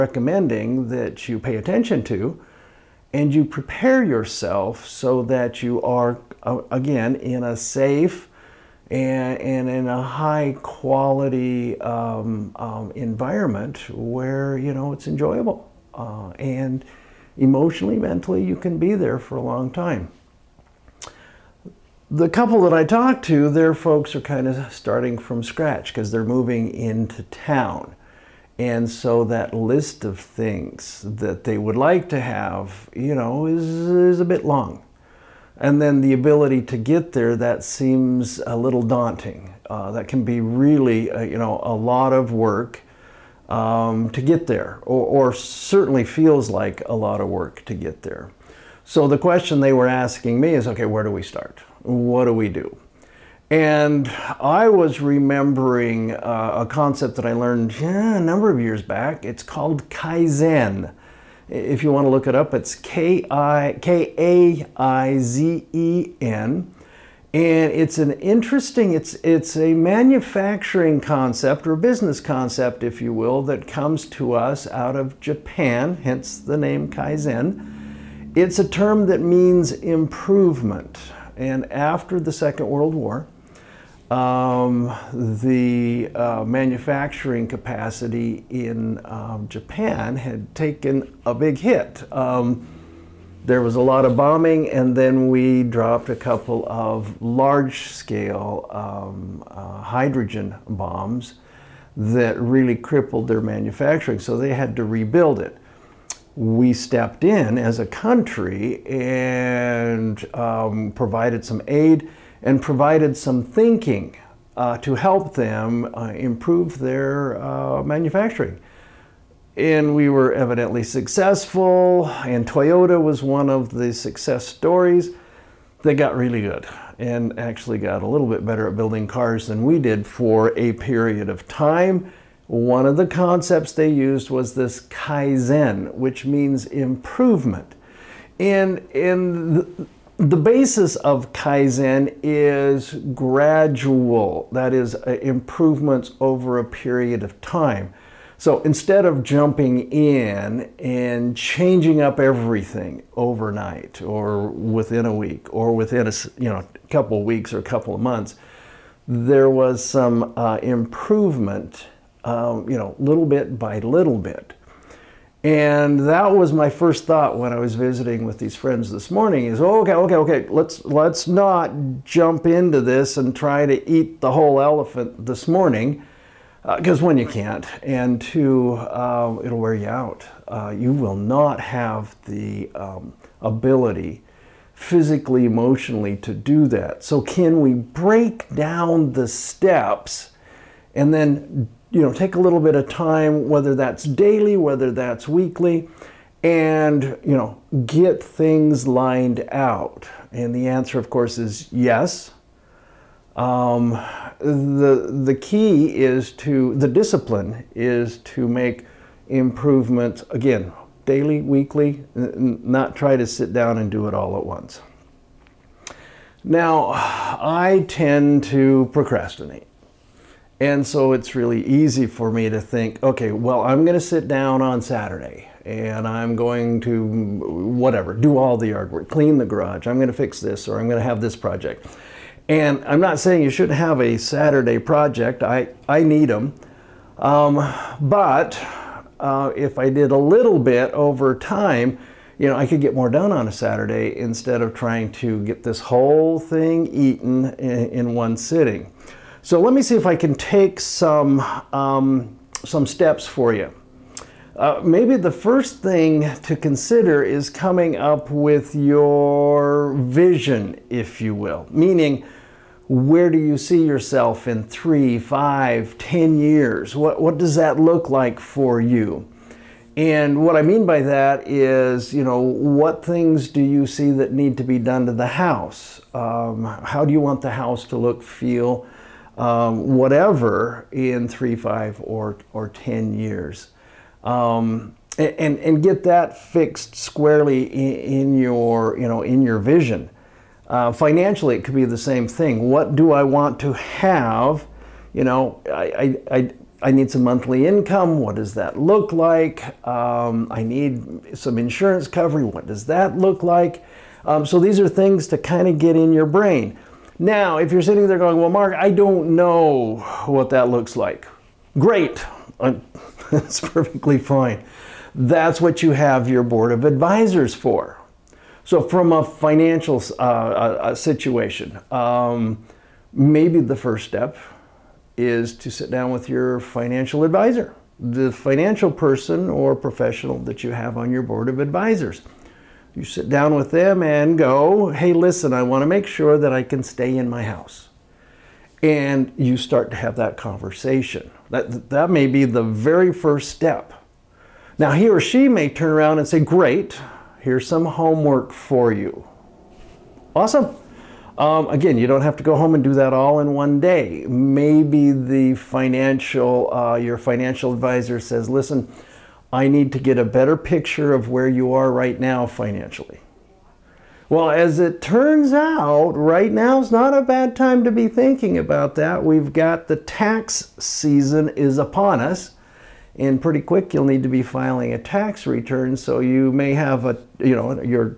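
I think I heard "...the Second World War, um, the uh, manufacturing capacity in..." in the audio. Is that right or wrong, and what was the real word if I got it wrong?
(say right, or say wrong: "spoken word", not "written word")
right.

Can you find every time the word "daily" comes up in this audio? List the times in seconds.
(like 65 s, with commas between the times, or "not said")
194 s, 211 s.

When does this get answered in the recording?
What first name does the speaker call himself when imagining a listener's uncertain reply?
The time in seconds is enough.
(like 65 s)
308 s.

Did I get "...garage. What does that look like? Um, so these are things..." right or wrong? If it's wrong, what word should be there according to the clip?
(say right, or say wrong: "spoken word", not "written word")
wrong: "coverage", not "garage".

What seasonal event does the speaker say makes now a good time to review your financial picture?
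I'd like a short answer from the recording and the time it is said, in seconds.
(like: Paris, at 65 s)
Tax season, at 369 s.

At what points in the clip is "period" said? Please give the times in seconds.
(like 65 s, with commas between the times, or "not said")
130 s, 146 s.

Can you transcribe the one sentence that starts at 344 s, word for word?
Now, he or she may turn around and say, great, here's some homework for you.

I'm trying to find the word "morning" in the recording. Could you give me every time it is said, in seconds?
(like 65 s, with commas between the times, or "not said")
169 s, 175 s.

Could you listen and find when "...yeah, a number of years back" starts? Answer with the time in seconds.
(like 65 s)
57 s.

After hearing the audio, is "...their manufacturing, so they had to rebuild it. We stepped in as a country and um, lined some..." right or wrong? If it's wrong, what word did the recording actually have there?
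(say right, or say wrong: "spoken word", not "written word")
wrong: "provided", not "lined".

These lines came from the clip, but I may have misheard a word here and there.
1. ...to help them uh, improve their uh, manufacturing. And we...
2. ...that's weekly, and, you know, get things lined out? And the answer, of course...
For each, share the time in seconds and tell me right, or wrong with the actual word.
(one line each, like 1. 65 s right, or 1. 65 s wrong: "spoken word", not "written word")
1. 114 s right
2. 194 s right.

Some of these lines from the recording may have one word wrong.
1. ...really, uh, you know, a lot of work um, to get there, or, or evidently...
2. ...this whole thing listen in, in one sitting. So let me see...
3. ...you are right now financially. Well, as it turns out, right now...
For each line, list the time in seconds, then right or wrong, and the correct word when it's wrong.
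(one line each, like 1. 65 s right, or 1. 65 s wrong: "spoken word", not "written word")
1. 40 s wrong: "certainly", not "evidently"
2. 245 s wrong: "eaten", not "listen"
3. 361 s right.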